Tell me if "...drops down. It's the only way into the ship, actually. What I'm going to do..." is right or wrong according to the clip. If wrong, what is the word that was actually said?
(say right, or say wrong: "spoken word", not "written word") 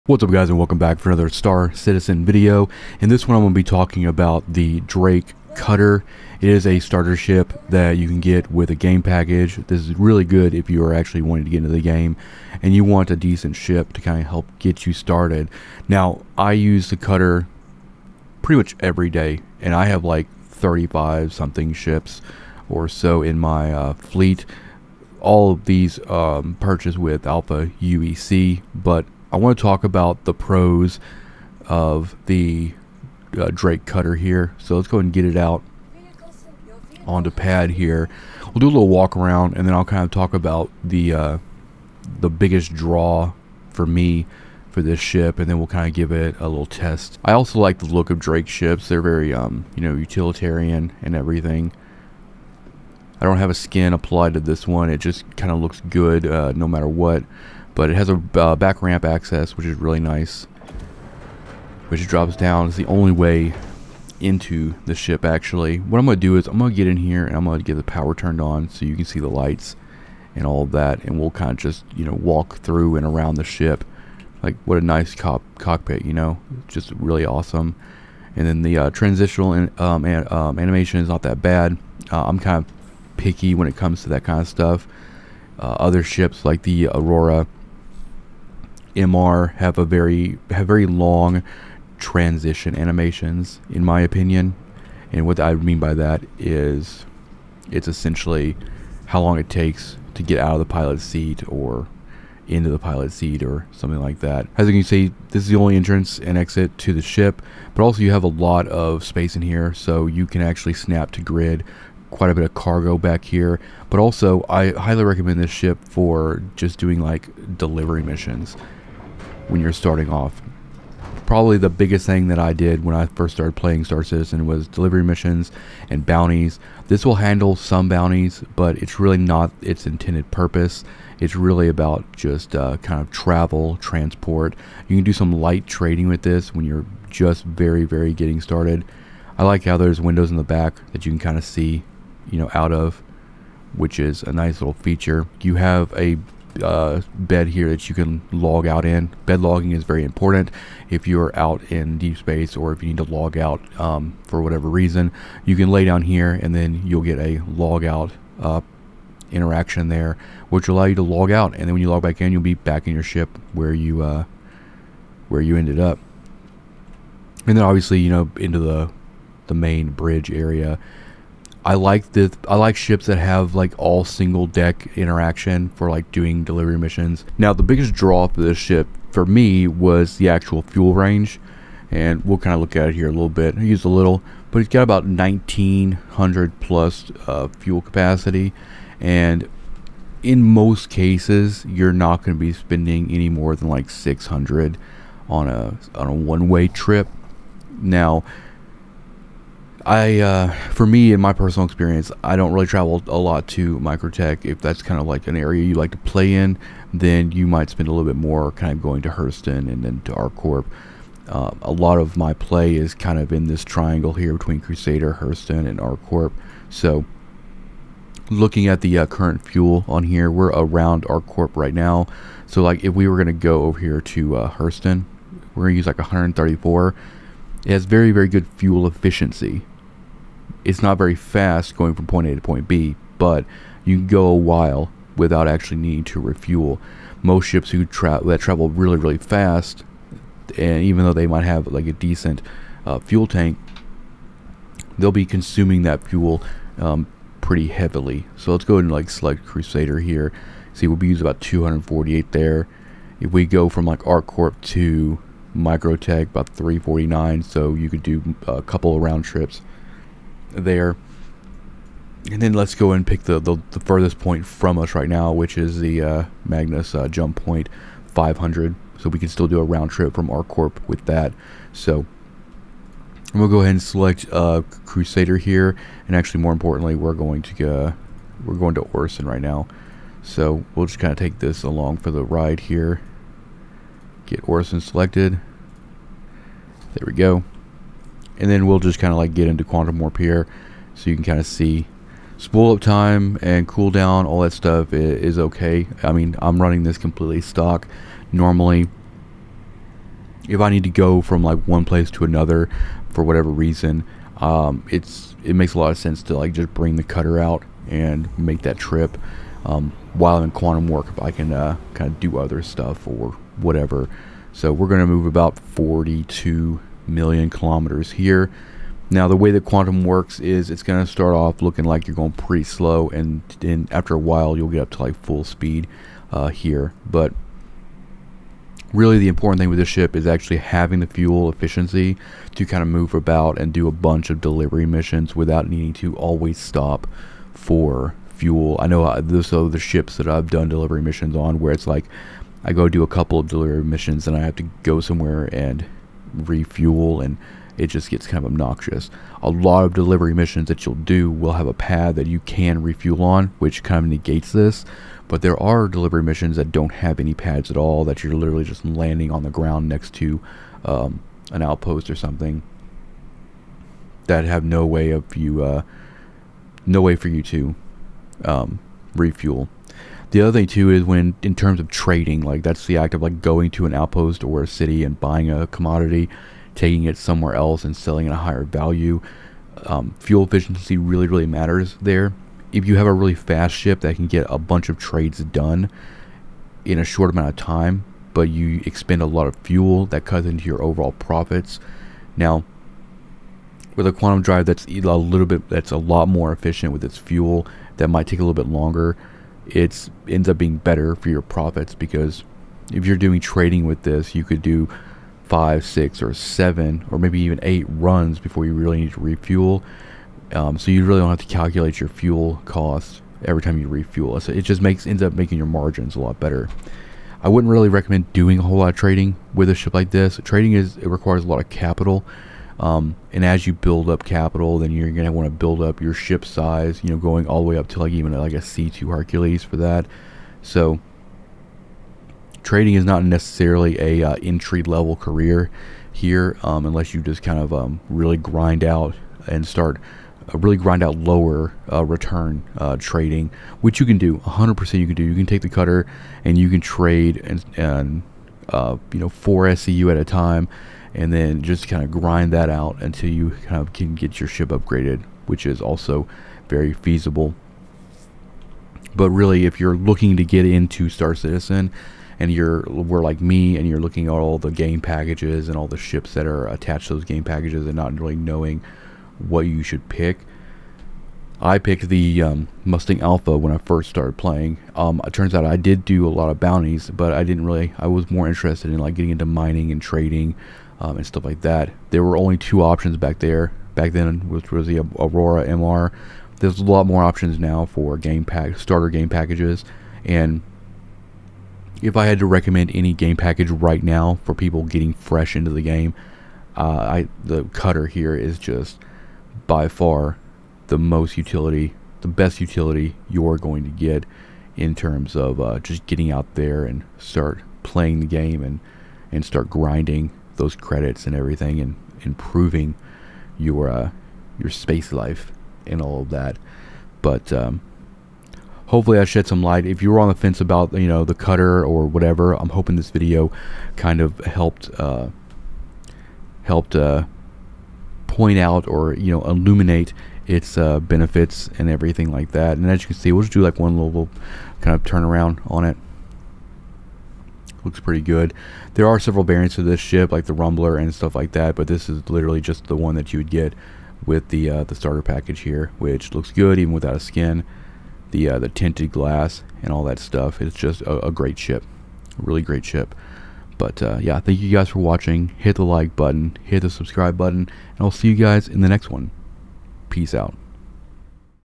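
right.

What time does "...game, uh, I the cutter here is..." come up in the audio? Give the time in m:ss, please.
8:15.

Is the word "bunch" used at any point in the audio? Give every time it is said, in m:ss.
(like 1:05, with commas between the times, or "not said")
5:33, 6:24.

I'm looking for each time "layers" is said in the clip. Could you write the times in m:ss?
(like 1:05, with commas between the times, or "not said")
not said.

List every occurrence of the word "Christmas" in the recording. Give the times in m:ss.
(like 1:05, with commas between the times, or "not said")
not said.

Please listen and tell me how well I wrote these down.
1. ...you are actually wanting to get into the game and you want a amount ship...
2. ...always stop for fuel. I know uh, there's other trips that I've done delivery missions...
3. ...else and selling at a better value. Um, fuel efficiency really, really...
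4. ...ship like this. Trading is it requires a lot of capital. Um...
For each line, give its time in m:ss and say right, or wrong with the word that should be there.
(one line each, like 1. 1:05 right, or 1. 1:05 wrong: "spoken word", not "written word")
1. 0:10 wrong: "decent", not "amount"
2. 5:36 wrong: "ships", not "trips"
3. 6:17 wrong: "higher", not "better"
4. 6:59 right.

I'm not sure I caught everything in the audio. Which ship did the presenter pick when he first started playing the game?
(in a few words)
Mustang Alpha.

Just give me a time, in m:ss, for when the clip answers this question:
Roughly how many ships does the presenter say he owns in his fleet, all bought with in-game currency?
0:20.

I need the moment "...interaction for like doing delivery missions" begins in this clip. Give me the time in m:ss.
2:54.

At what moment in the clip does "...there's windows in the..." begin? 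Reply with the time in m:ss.
2:19.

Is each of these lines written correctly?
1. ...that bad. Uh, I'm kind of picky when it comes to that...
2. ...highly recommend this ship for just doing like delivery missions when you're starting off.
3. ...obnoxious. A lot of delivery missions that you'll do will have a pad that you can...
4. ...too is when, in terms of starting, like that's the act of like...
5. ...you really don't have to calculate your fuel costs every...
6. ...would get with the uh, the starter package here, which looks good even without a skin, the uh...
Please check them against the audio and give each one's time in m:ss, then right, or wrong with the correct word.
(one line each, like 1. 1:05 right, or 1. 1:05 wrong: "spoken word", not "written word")
1. 1:21 right
2. 1:54 right
3. 5:48 right
4. 6:10 wrong: "trading", not "starting"
5. 6:50 right
6. 9:03 right.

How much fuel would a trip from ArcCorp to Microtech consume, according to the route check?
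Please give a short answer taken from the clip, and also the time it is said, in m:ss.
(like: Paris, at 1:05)
349, at 4:16.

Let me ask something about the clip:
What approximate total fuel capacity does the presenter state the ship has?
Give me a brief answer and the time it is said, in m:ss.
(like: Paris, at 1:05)
1900, at 3:05.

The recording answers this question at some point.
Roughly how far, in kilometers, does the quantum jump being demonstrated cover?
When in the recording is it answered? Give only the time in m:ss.
5:15.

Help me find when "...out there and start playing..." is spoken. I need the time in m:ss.
8:26.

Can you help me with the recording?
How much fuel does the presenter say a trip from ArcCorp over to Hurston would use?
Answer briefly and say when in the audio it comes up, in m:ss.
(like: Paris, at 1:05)
134, at 3:45.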